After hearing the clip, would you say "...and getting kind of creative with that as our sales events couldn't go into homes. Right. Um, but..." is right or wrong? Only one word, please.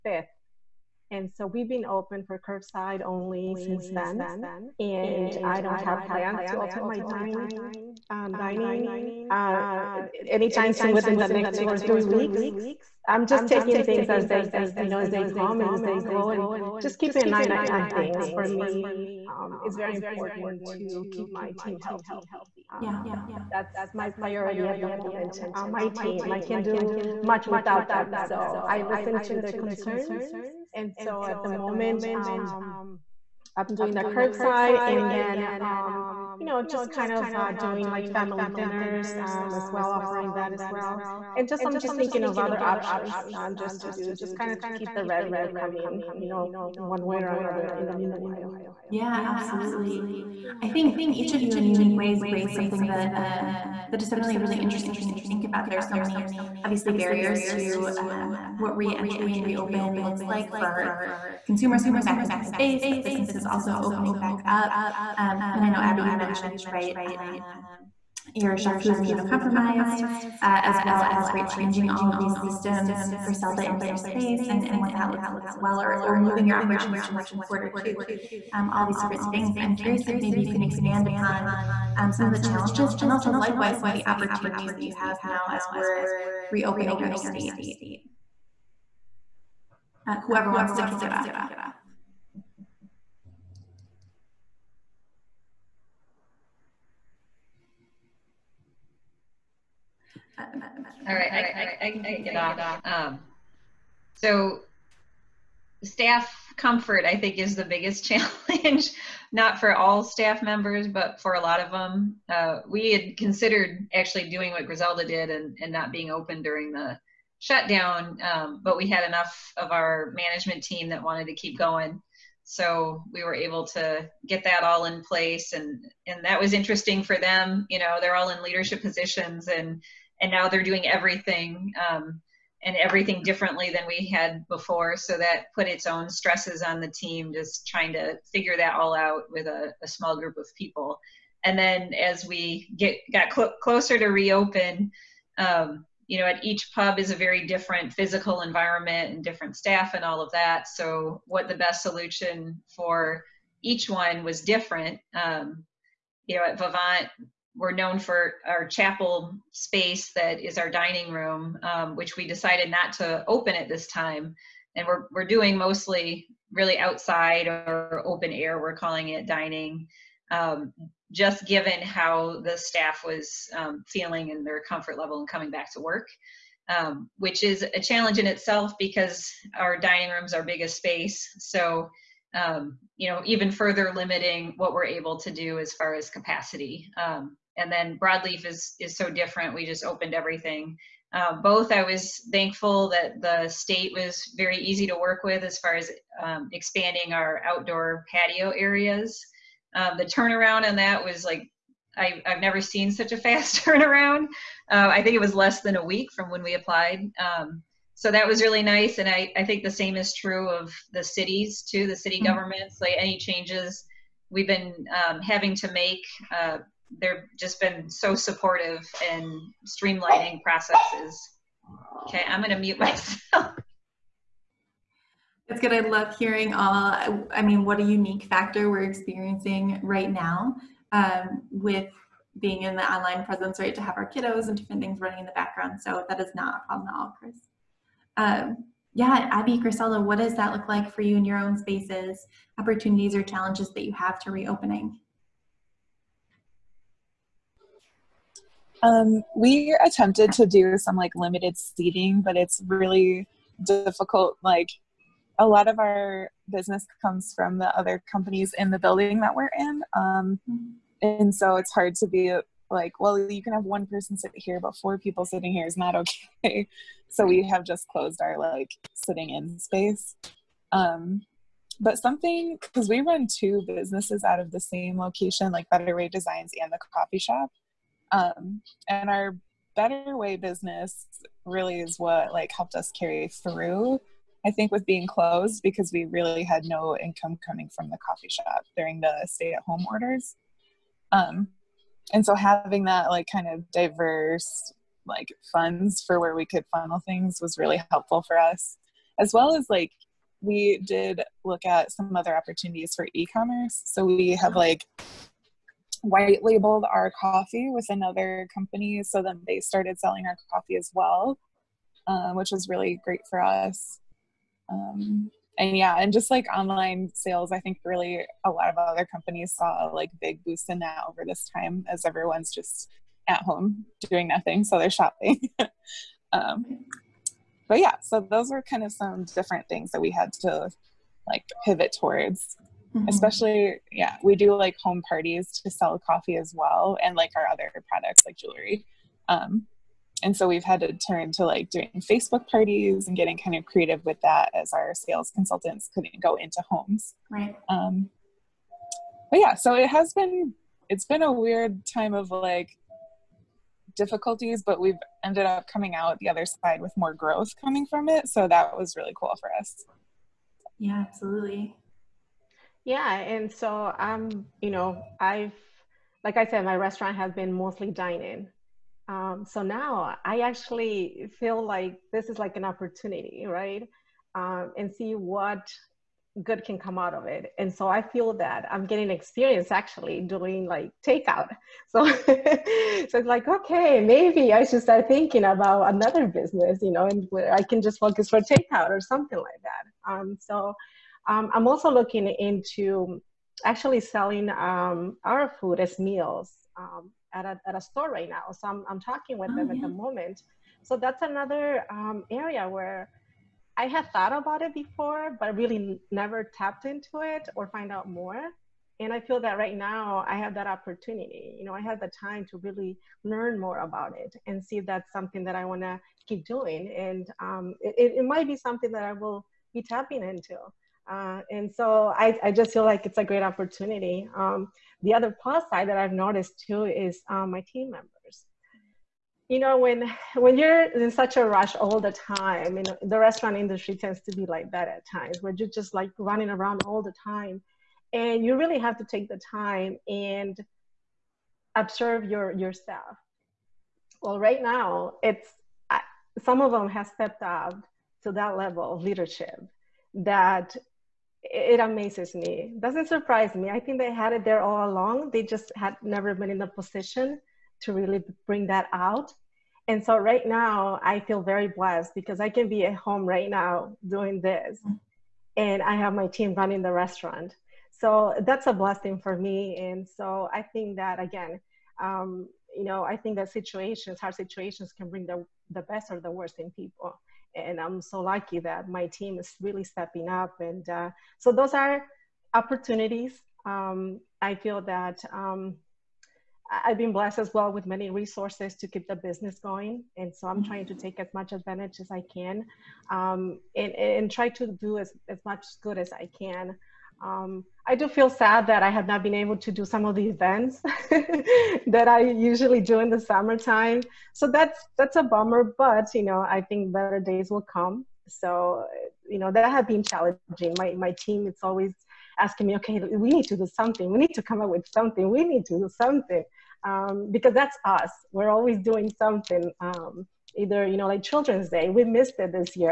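wrong.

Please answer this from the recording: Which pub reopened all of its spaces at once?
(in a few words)
Broadleaf.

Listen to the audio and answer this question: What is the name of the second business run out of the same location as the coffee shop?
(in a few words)
Better Way Designs.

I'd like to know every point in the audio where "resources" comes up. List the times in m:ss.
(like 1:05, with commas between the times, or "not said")
8:08.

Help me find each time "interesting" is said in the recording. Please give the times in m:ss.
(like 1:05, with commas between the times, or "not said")
0:54, 2:06.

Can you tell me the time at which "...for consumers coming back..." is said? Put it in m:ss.
1:00.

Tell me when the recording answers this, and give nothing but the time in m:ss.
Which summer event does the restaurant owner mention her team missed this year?
8:41.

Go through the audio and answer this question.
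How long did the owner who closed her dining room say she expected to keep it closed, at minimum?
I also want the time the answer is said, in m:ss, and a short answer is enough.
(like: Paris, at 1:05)
two or three weeks, at 0:11.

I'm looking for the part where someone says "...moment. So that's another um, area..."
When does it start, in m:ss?
6:39.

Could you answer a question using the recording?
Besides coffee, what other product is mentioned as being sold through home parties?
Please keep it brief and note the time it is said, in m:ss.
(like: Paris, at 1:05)
jewelry, at 5:38.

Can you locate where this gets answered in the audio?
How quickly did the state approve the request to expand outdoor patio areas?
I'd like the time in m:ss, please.
3:25.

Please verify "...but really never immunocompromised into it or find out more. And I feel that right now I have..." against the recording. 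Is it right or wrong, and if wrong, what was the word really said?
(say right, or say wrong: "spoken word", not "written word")
wrong: "tapped", not "immunocompromised".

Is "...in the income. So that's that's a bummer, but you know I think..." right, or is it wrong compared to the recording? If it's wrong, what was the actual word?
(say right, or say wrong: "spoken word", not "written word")
wrong: "summertime", not "income".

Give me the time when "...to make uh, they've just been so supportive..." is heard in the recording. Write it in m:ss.
3:35.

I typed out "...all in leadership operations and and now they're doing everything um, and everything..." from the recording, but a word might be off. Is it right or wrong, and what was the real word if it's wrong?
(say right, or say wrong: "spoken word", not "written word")
wrong: "positions", not "operations".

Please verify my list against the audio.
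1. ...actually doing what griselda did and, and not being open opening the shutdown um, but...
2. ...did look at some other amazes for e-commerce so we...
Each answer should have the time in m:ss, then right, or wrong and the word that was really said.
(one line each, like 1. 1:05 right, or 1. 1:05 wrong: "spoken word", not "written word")
1. 1:53 wrong: "during", not "opening"
2. 5:00 wrong: "opportunities", not "amazes".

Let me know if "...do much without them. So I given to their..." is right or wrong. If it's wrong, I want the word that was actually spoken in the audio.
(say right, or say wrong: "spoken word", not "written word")
wrong: "listen", not "given".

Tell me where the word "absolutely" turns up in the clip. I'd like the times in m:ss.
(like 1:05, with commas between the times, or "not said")
0:49, 6:01.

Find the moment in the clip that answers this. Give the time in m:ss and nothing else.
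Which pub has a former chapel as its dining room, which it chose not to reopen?
2:36.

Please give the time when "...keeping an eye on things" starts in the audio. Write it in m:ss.
0:16.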